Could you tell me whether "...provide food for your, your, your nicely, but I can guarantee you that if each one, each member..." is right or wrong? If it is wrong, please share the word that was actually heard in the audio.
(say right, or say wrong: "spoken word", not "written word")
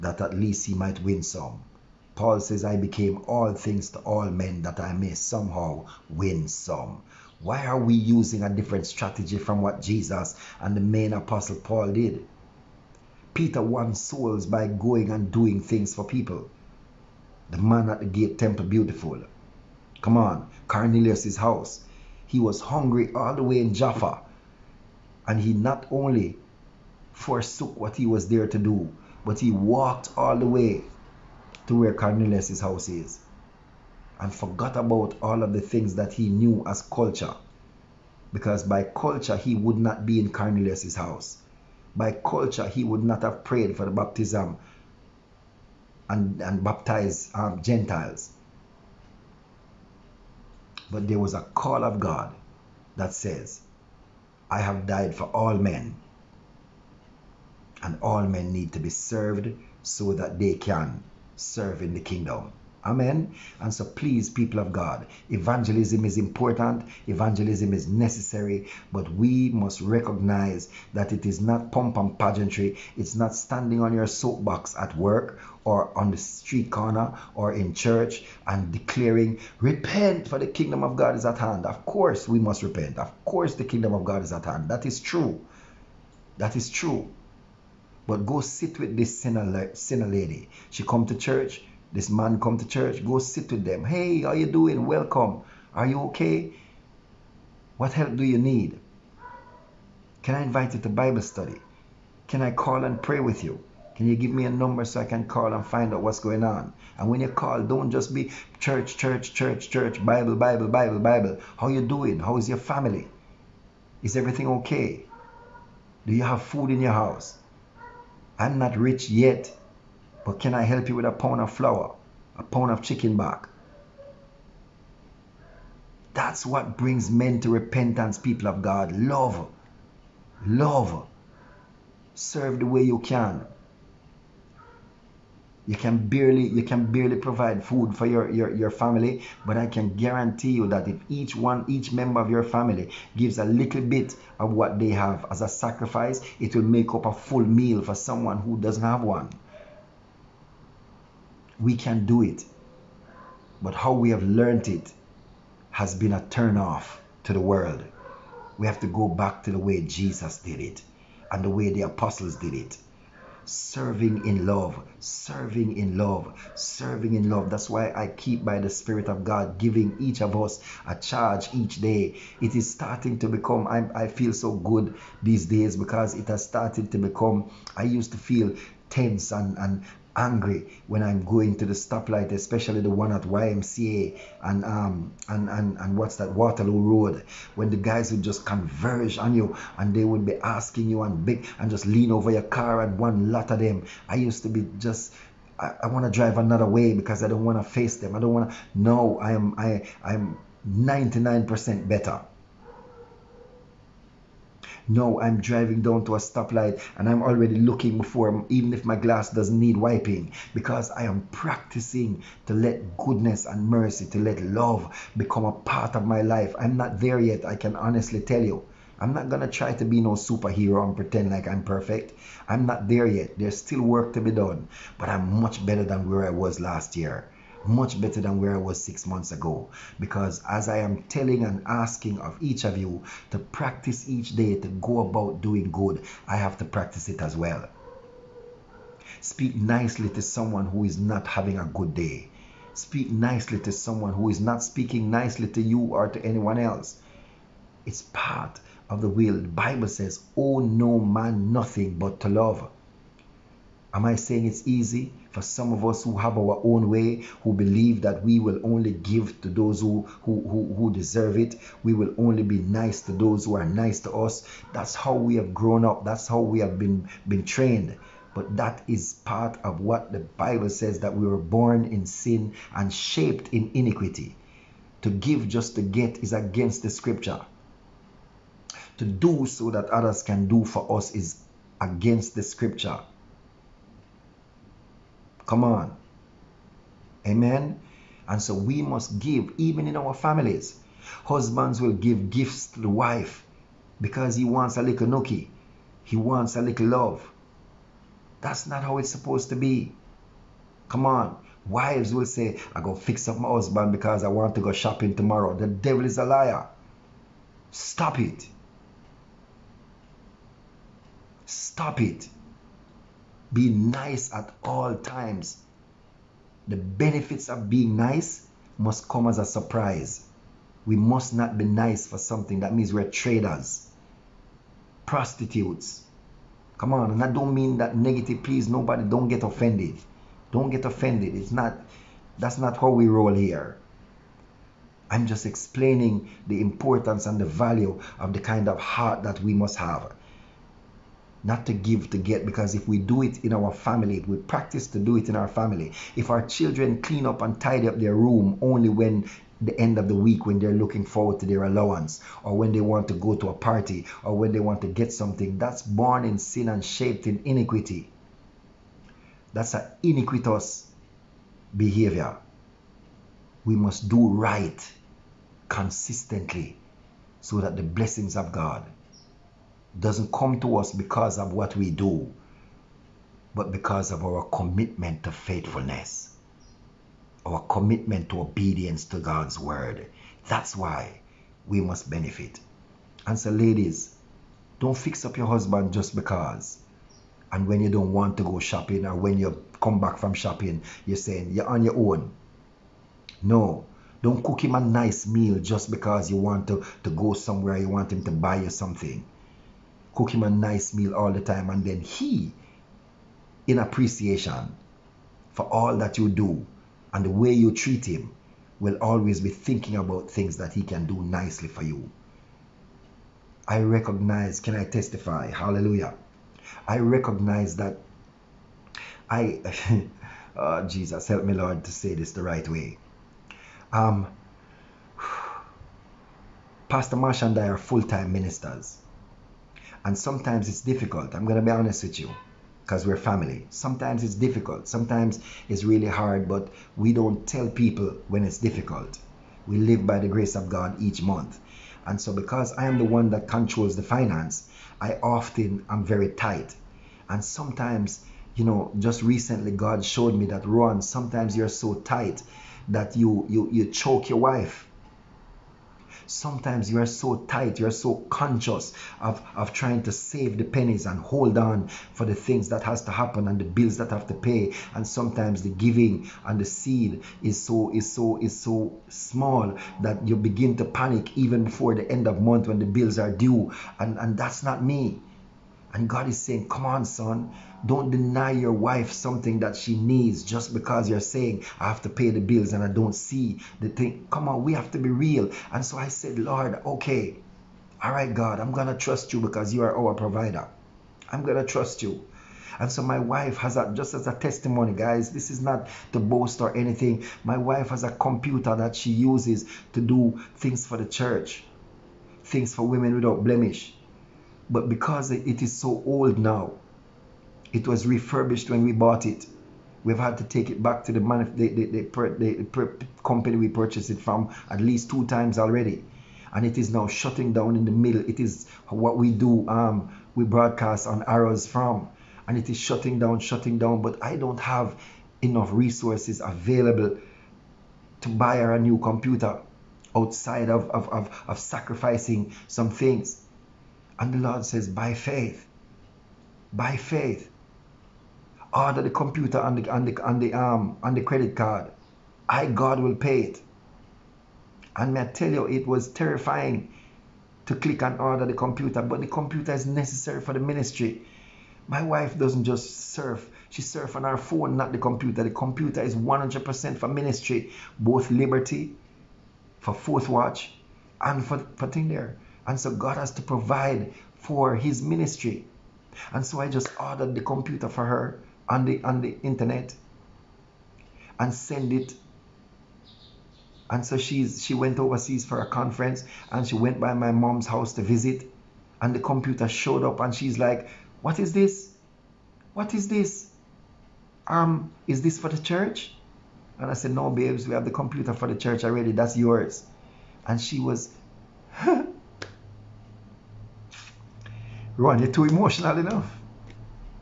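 wrong: "family", not "nicely".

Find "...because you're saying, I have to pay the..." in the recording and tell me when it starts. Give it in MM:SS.
08:00.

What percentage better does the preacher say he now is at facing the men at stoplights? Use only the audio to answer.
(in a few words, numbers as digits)
99%.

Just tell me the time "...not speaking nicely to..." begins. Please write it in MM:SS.
04:04.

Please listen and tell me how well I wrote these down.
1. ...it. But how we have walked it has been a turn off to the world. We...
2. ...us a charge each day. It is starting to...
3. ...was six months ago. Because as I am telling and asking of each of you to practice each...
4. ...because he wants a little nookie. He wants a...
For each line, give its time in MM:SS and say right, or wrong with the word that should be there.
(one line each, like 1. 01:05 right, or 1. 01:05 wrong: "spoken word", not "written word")
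1. 02:32 wrong: "learned", not "walked"
2. 02:50 right
3. 03:48 right
4. 04:53 right.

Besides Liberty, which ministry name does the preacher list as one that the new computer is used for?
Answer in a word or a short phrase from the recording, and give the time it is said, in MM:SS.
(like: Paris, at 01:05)
Fourth Watch, at 09:19.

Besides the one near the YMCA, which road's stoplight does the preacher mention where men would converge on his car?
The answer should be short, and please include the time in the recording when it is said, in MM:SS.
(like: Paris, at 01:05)
Waterloo Road, at 03:06.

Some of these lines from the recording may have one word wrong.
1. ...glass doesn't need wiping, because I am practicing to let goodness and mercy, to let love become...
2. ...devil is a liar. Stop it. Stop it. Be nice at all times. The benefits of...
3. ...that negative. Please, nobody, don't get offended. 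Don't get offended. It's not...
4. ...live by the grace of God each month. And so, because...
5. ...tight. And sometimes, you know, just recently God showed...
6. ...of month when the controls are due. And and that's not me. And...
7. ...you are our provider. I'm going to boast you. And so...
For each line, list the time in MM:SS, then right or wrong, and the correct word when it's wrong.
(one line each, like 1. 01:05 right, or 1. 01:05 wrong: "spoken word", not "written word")
1. 03:28 right
2. 05:05 right
3. 05:27 right
4. 07:19 right
5. 07:26 right
6. 07:52 wrong: "bills", not "controls"
7. 08:09 wrong: "trust", not "boast".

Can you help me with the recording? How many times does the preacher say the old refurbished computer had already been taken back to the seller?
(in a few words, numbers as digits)
2.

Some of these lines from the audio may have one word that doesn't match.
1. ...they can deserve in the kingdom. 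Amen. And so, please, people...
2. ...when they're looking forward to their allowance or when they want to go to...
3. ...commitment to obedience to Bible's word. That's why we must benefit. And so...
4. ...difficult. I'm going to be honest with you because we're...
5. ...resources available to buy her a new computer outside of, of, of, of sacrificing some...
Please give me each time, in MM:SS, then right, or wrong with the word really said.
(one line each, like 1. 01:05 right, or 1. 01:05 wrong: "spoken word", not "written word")
1. 01:00 wrong: "serve", not "deserve"
2. 05:50 right
3. 06:17 wrong: "God", not "Bible"
4. 07:10 right
5. 08:45 right.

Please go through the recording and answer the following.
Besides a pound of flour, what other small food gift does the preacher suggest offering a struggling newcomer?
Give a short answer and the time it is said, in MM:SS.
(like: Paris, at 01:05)
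a pound of chicken back, at 02:02.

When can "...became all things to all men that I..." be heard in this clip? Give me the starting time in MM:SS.
00:02.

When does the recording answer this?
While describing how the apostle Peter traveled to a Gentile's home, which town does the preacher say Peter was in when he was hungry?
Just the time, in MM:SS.
00:23.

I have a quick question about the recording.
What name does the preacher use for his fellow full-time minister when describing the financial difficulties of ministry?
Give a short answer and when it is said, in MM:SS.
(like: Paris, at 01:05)
Pastor Marsh, at 07:06.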